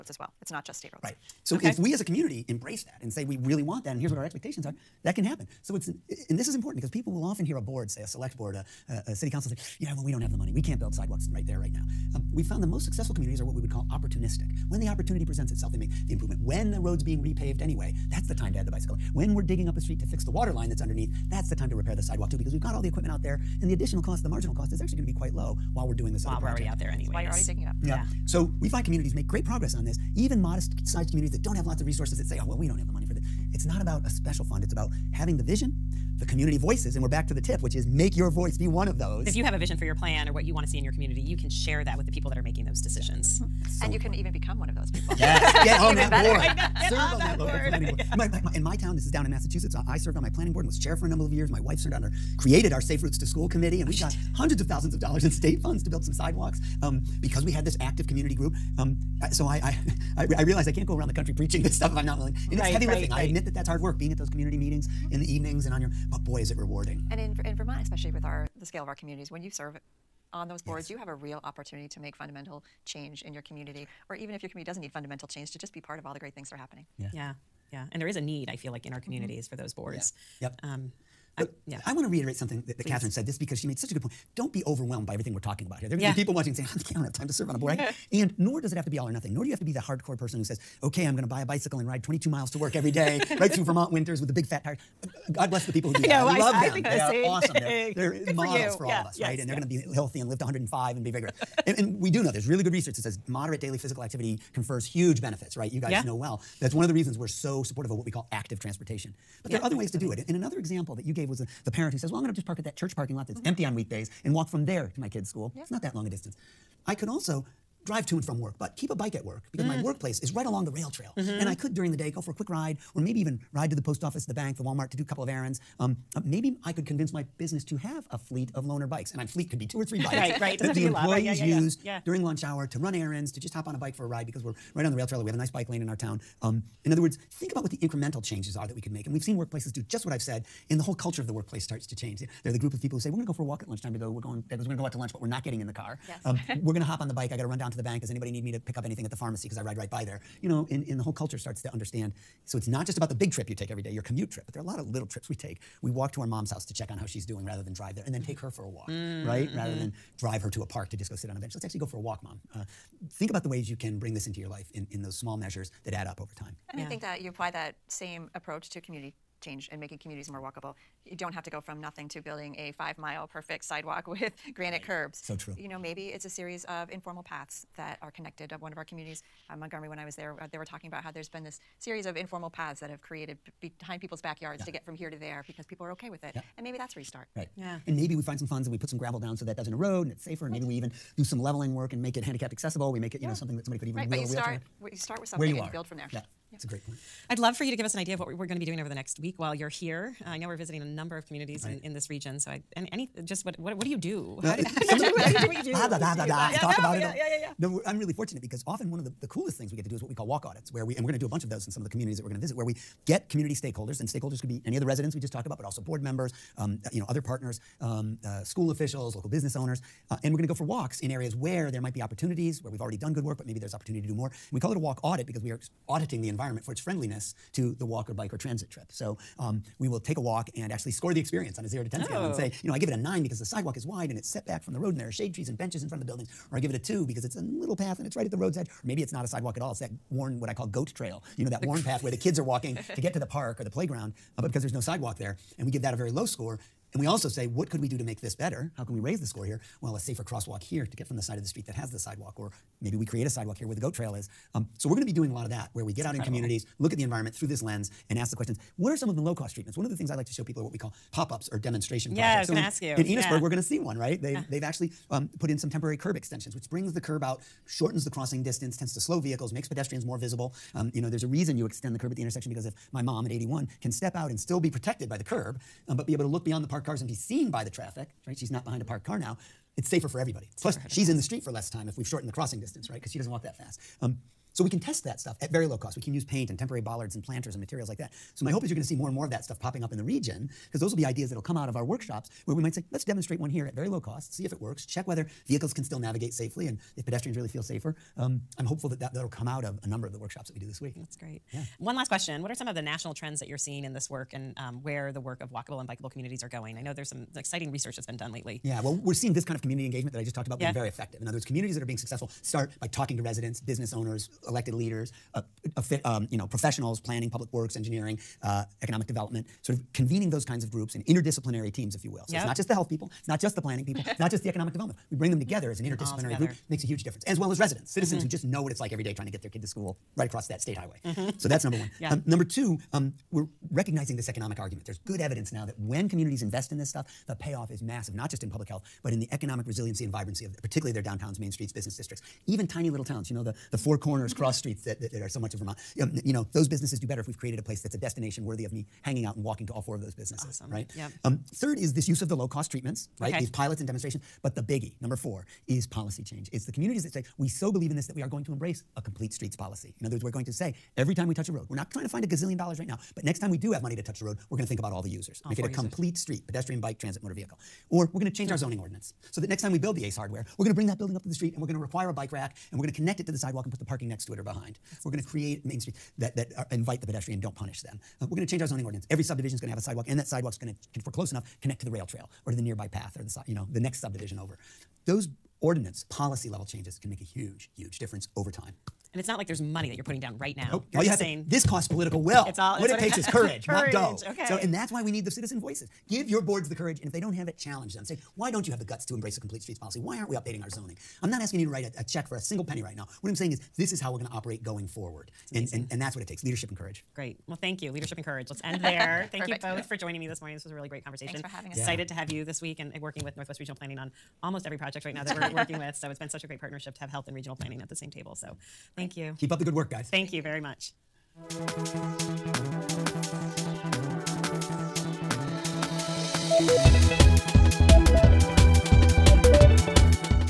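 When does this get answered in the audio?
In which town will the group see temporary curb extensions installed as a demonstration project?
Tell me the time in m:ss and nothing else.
4:23.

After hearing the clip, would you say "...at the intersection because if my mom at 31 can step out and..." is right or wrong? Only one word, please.
wrong.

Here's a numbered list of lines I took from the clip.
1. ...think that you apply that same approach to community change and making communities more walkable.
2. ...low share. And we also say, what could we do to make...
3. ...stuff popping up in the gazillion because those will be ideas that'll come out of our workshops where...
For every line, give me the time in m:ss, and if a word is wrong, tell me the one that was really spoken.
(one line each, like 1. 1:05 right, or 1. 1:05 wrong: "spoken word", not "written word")
1. 2:46 right
2. 4:06 wrong: "score", not "share"
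3. 4:49 wrong: "region", not "gazillion".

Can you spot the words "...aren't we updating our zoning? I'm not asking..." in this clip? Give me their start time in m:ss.
6:40.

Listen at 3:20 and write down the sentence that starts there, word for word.
Uh, I know we're visiting a number of communities right.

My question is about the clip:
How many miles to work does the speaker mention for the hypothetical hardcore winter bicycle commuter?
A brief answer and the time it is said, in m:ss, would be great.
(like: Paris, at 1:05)
22, at 1:32.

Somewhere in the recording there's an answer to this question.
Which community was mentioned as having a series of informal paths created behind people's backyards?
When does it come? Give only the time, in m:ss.
2:59.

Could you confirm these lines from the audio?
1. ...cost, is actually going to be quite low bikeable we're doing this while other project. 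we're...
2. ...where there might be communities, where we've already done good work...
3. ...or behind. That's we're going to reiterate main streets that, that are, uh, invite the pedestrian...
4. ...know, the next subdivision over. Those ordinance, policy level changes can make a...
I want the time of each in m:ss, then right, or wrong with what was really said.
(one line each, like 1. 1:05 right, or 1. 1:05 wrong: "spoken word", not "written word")
1. 0:24 wrong: "while", not "bikeable"
2. 3:41 wrong: "opportunities", not "communities"
3. 6:14 wrong: "create", not "reiterate"
4. 6:23 right.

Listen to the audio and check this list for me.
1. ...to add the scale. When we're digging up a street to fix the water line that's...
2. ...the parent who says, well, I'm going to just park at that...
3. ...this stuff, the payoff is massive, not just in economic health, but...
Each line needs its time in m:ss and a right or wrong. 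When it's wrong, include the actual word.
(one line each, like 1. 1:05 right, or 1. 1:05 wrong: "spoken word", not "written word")
1. 0:18 wrong: "bicycle", not "scale"
2. 1:51 right
3. 5:36 wrong: "public", not "economic".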